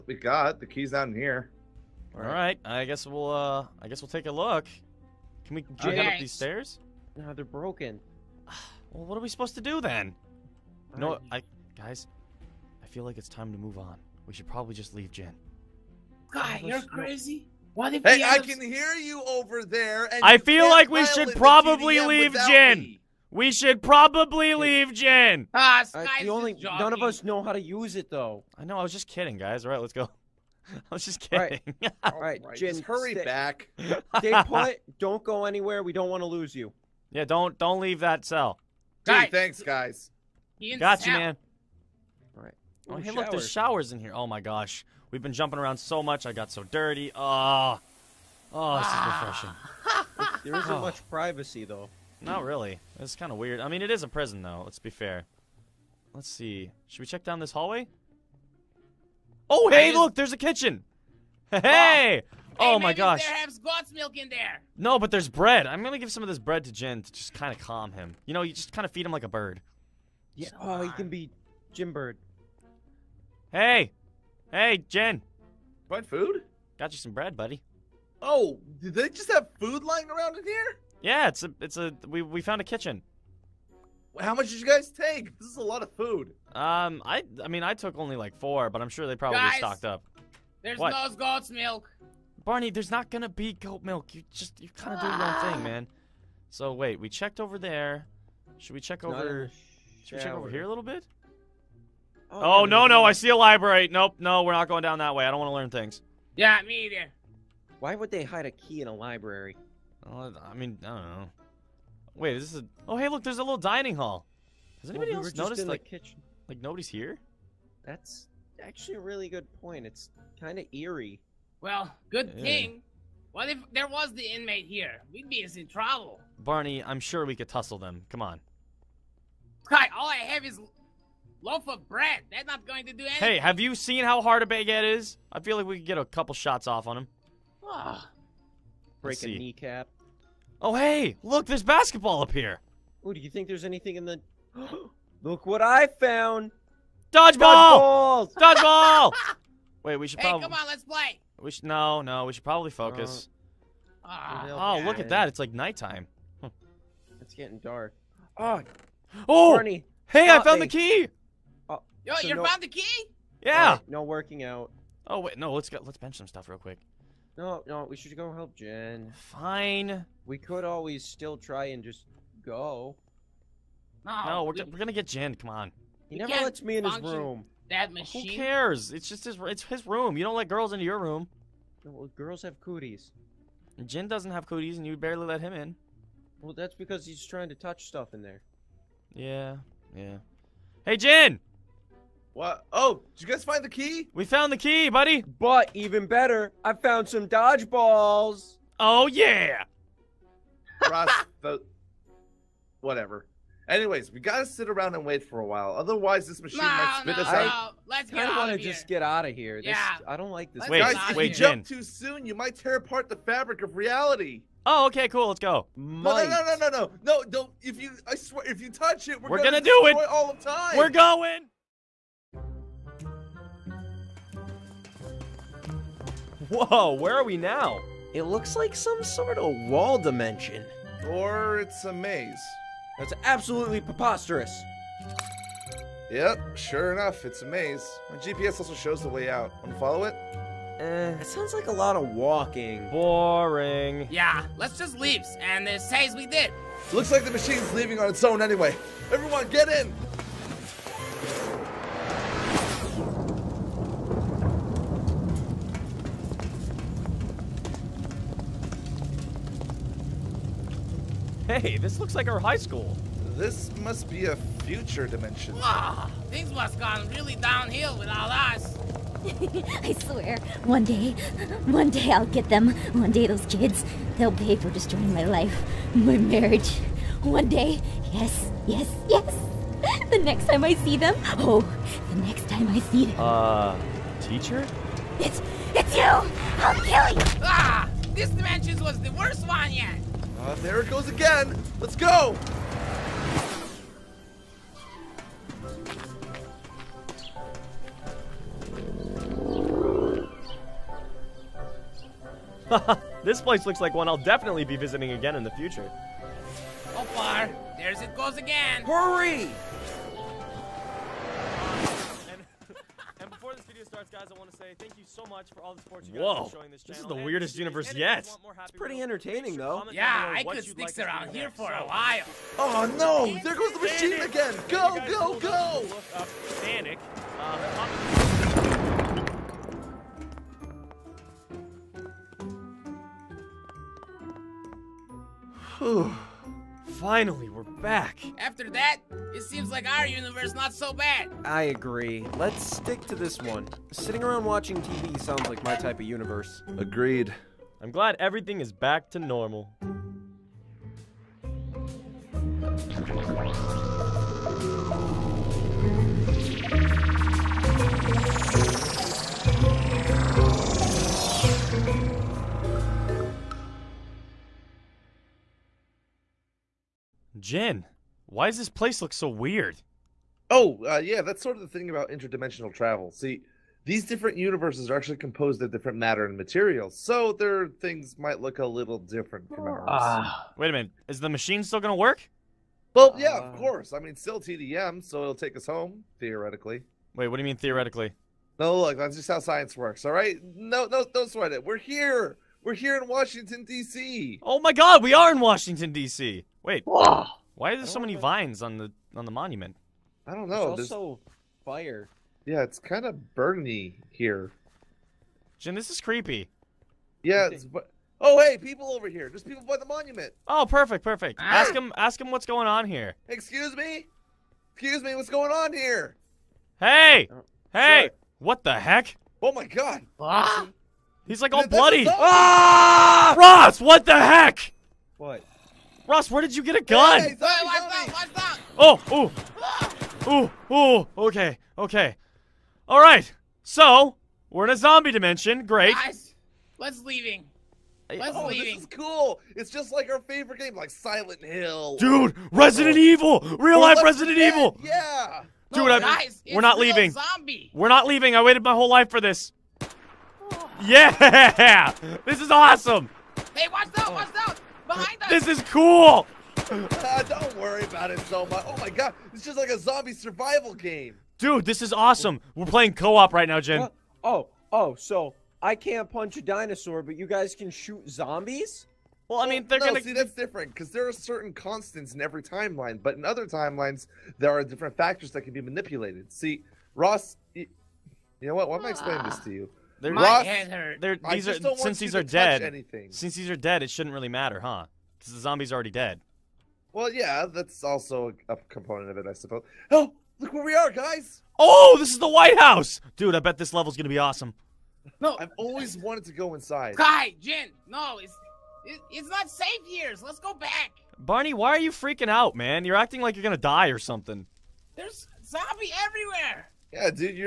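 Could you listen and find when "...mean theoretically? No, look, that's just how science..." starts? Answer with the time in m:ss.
6:27.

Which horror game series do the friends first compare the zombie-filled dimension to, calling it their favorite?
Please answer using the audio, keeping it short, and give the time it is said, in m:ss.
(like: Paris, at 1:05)
Silent Hill, at 7:20.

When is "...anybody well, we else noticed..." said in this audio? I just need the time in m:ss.
1:54.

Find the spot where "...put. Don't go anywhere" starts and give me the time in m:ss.
0:34.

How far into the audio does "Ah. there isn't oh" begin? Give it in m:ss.
0:50.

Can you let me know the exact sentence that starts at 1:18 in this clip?
Oh, did they just have food lying around in here?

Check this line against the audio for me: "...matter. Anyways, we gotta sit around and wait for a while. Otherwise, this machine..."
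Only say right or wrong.
wrong.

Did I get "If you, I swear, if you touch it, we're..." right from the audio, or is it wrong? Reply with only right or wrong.
right.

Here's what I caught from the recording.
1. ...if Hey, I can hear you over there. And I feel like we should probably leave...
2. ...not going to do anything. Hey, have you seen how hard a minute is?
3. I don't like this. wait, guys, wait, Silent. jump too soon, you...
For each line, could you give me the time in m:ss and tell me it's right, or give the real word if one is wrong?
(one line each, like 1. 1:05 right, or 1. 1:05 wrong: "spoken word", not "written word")
1. 0:17 right
2. 2:12 wrong: "baguette", not "minute"
3. 3:30 wrong: "Jen", not "Silent".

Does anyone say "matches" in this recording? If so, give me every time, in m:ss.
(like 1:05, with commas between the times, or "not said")
not said.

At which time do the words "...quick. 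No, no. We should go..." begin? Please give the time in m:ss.
2:46.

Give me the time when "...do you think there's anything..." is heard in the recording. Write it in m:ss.
2:23.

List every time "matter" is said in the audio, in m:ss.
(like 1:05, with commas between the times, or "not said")
6:15, 8:04.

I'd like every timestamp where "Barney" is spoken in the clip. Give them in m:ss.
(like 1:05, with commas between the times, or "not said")
1:32, 2:06, 8:21.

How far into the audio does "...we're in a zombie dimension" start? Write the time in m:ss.
7:14.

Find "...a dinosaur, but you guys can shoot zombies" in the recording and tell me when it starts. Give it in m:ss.
7:46.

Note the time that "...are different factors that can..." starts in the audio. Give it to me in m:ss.
7:54.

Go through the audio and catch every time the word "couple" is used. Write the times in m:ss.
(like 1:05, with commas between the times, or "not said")
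2:16.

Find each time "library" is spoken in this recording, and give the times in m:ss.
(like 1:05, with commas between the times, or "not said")
1:43, 1:48.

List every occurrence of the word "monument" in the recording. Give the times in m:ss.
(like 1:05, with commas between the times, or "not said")
6:39, 6:49.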